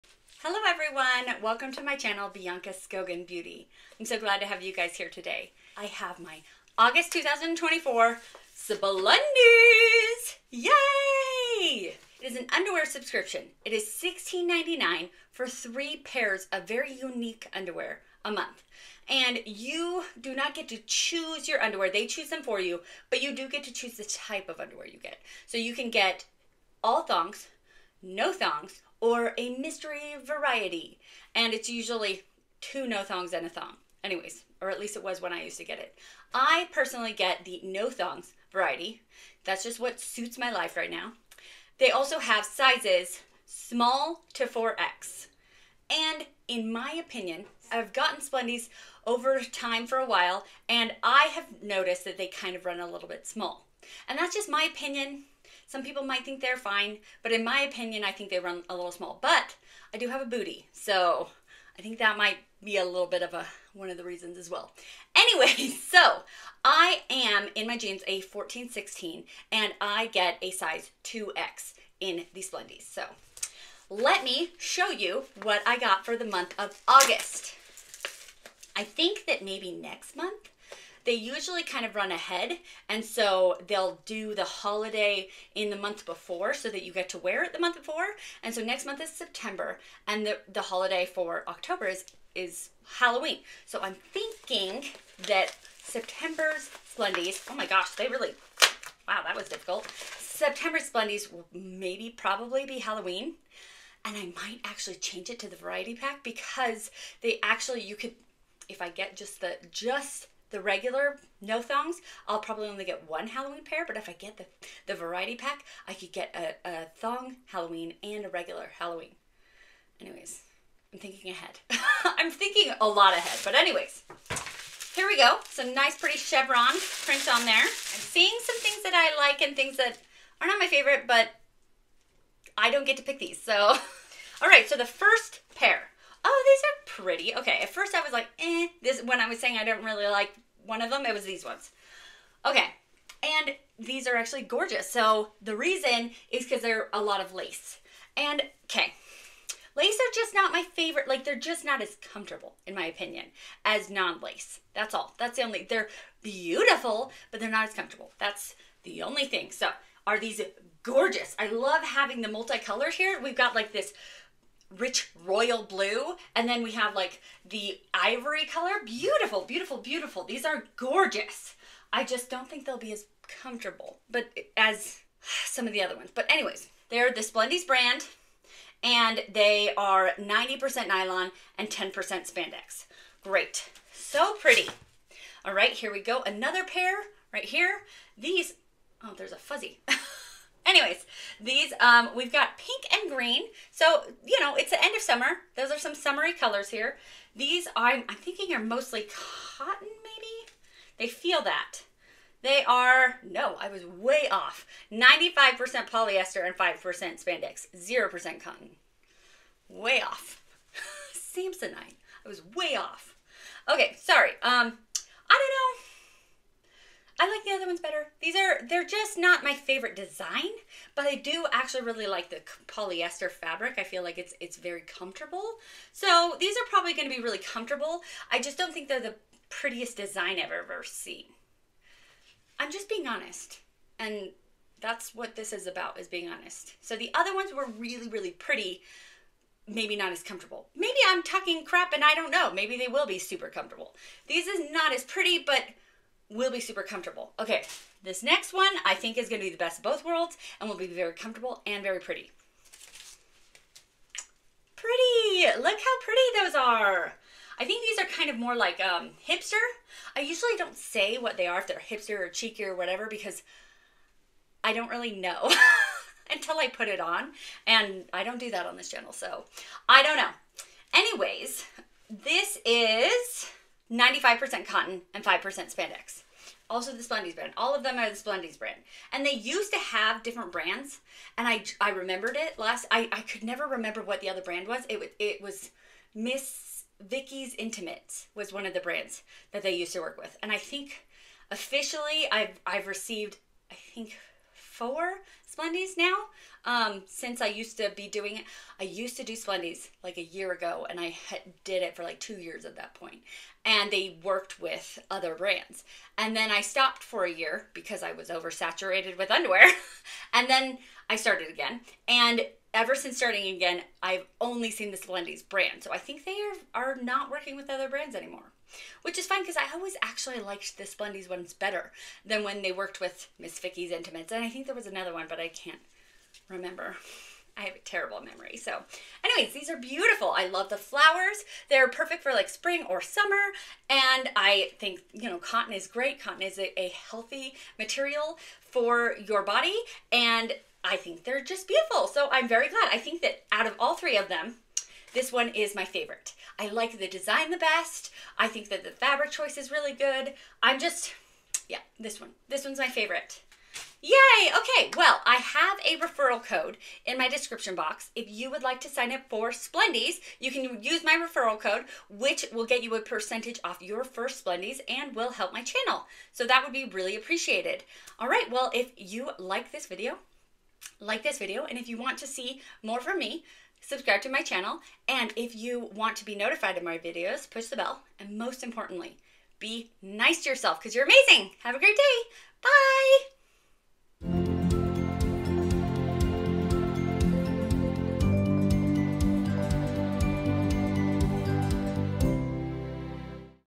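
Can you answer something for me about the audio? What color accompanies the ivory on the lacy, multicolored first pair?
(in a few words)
royal blue.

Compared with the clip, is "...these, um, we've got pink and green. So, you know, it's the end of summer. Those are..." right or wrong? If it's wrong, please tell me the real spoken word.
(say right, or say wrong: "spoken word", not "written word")
right.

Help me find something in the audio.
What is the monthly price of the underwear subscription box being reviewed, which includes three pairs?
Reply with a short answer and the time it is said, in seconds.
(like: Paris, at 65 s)
$16.99, at 13 s.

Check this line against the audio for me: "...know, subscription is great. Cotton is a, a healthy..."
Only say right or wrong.
wrong.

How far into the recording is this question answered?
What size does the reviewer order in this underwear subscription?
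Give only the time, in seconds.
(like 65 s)
71 s.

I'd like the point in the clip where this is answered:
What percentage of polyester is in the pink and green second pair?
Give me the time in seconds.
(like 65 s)
204 s.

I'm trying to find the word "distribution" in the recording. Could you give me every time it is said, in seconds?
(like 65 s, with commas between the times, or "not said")
not said.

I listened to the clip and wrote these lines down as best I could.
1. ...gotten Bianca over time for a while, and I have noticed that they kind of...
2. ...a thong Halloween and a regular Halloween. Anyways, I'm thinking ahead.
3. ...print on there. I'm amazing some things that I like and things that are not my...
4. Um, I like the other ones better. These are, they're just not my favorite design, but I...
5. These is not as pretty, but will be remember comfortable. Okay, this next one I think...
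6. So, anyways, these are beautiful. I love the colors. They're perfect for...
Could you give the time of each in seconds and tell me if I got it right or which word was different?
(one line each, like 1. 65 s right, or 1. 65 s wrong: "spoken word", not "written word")
1. 47 s wrong: "Splendies", not "Bianca"
2. 116 s right
3. 127 s wrong: "seeing", not "amazing"
4. 214 s right
5. 244 s wrong: "super", not "remember"
6. 328 s wrong: "flowers", not "colors".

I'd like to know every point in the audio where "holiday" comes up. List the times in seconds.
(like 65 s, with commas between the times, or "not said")
84 s, 90 s.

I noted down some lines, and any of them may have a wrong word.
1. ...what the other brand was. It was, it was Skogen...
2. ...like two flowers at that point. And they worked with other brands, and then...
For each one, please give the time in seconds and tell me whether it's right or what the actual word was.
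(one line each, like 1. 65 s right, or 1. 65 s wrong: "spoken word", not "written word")
1. 284 s wrong: "Miss", not "Skogen"
2. 302 s wrong: "years", not "flowers".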